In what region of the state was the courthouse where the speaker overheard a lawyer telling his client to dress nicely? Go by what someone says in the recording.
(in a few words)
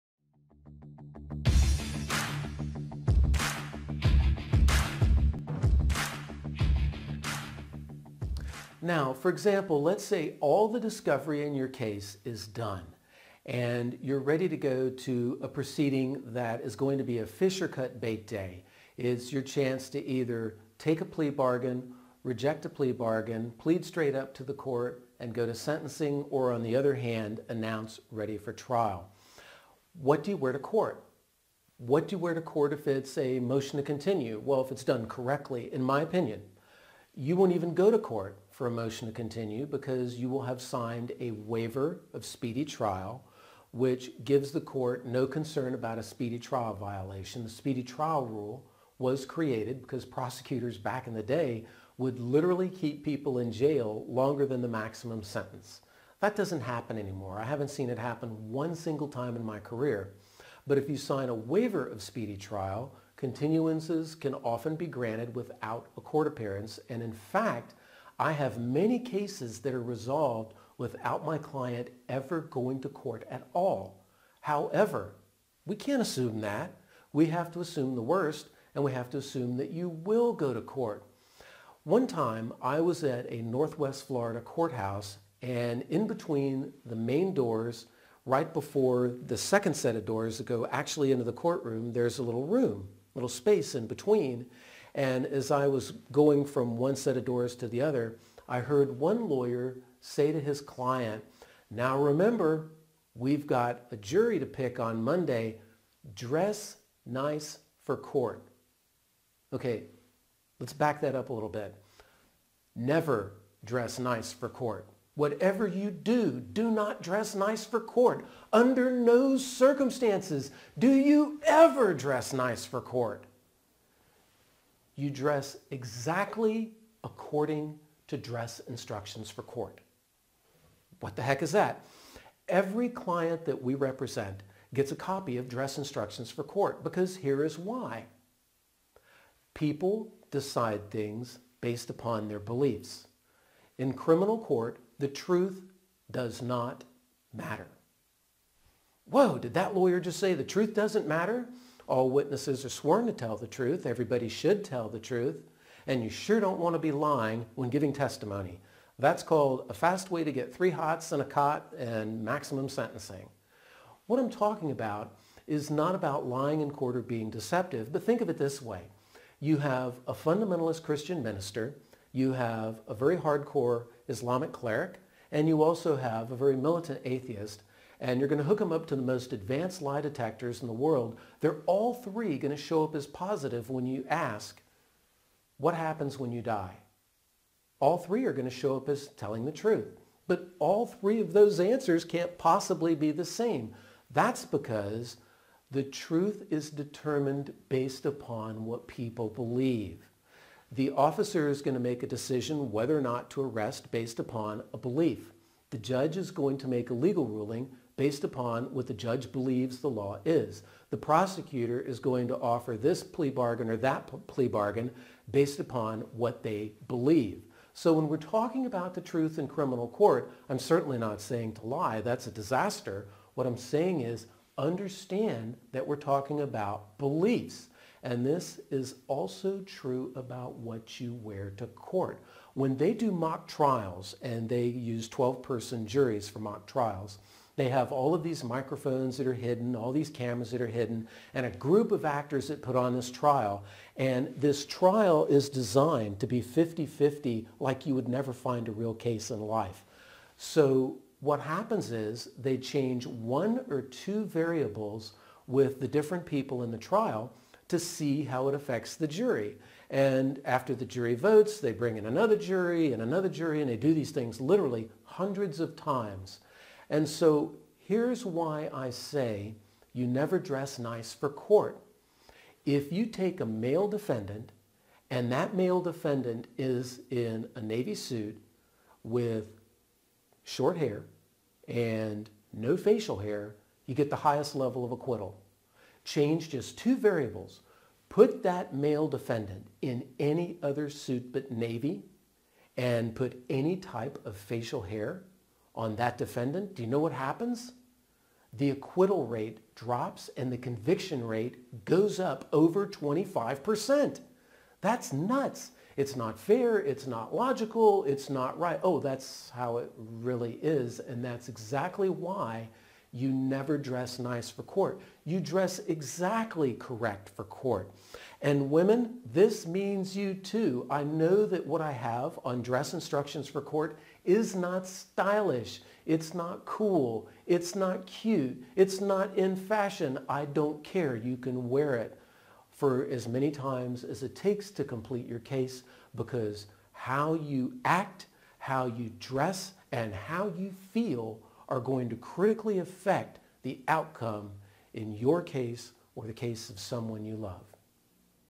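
Northwest Florida.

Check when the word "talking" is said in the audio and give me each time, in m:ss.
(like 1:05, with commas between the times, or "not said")
2:44, 3:38, 3:45.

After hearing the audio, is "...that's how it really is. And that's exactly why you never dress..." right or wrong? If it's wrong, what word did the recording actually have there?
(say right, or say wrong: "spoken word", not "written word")
right.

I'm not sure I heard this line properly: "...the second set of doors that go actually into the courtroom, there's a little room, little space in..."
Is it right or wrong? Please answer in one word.
right.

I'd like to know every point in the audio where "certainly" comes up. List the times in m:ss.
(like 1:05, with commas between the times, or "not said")
3:40.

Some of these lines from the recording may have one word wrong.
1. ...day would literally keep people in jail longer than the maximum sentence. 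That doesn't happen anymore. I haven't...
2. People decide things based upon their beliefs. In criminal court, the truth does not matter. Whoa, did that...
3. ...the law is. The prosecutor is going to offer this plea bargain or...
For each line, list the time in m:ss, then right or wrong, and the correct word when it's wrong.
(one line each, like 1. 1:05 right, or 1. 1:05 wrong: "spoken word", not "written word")
1. 0:51 right
2. 2:19 right
3. 3:29 right.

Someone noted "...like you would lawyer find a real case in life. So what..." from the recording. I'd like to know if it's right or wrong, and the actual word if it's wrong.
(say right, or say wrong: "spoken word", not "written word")
wrong: "never", not "lawyer".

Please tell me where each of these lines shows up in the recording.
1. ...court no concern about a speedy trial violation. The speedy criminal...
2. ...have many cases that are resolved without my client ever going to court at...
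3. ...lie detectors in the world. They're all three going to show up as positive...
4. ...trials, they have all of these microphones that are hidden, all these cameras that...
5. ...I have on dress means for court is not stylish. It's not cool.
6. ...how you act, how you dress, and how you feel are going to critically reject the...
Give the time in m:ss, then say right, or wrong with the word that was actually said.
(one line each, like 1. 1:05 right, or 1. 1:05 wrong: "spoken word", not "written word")
1. 0:44 wrong: "trial", not "criminal"
2. 1:08 right
3. 2:59 right
4. 3:56 right
5. 5:21 wrong: "instructions", not "means"
6. 5:36 wrong: "affect", not "reject".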